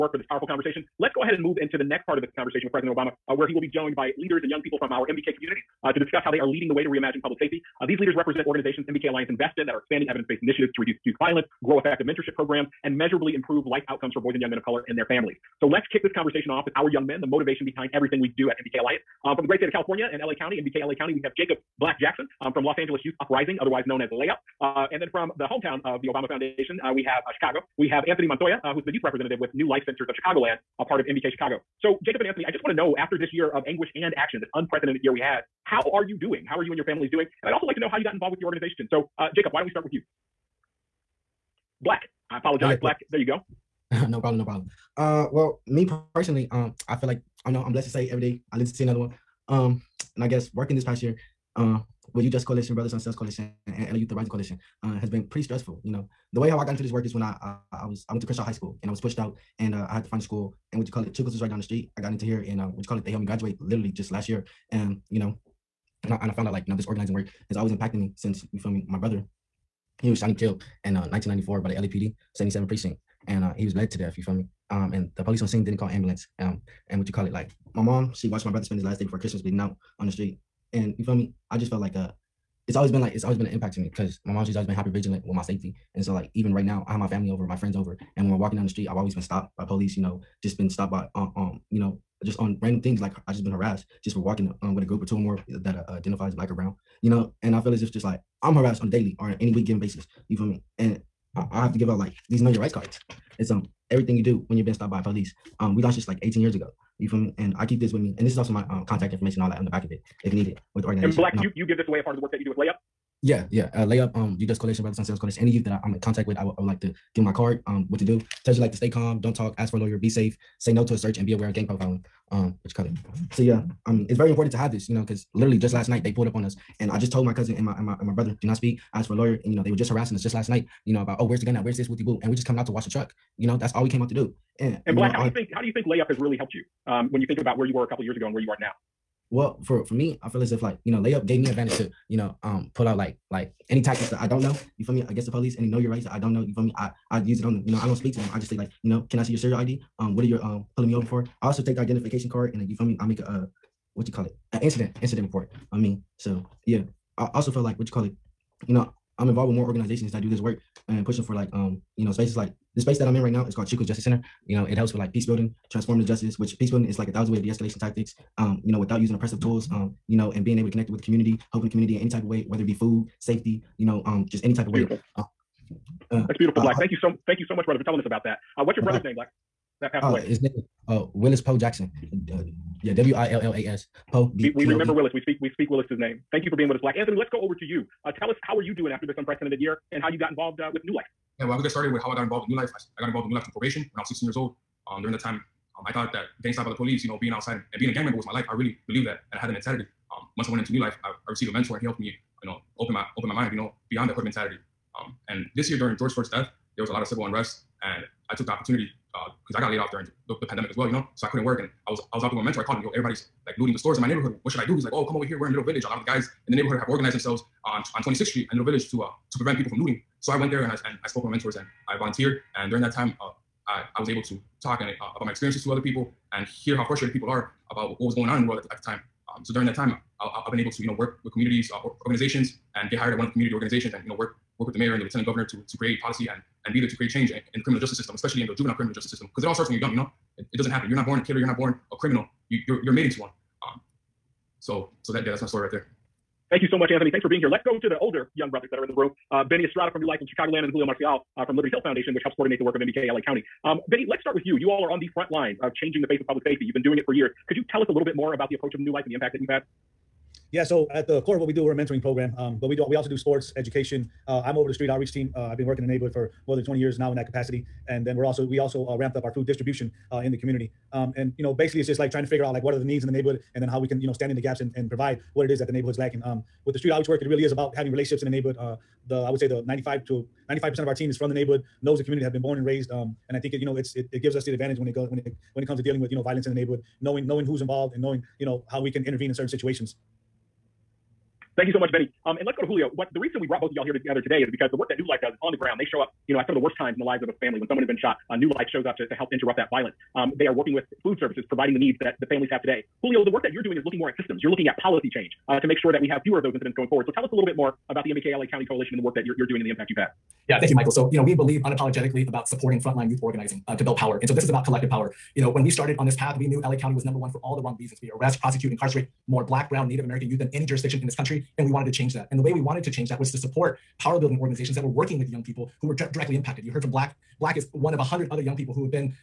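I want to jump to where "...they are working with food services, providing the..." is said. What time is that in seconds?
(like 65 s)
300 s.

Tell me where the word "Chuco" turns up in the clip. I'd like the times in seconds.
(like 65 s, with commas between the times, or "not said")
61 s, 163 s.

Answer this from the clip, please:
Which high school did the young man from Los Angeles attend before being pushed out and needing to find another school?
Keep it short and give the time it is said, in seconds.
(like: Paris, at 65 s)
Crenshaw High School, at 58 s.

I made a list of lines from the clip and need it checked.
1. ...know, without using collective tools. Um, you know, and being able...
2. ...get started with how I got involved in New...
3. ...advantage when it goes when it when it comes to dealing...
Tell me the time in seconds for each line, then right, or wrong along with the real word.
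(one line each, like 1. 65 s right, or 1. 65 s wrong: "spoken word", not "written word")
1. 168 s wrong: "oppressive", not "collective"
2. 191 s right
3. 284 s right.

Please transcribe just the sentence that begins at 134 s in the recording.
And, and black, know, how I, do you think how do you think layup has really helped you?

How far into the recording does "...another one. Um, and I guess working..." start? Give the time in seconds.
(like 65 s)
48 s.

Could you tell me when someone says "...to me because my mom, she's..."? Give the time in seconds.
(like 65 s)
83 s.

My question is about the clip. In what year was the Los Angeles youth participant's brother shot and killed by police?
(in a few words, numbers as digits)
1994.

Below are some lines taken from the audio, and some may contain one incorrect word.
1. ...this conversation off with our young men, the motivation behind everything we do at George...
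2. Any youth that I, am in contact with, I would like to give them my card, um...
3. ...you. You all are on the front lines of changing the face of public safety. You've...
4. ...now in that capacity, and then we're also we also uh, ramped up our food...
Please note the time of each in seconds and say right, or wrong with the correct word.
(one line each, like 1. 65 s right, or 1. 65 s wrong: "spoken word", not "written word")
1. 16 s wrong: "MBK", not "George"
2. 115 s right
3. 254 s right
4. 266 s right.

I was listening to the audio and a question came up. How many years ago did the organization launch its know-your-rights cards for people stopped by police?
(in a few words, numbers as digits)
18.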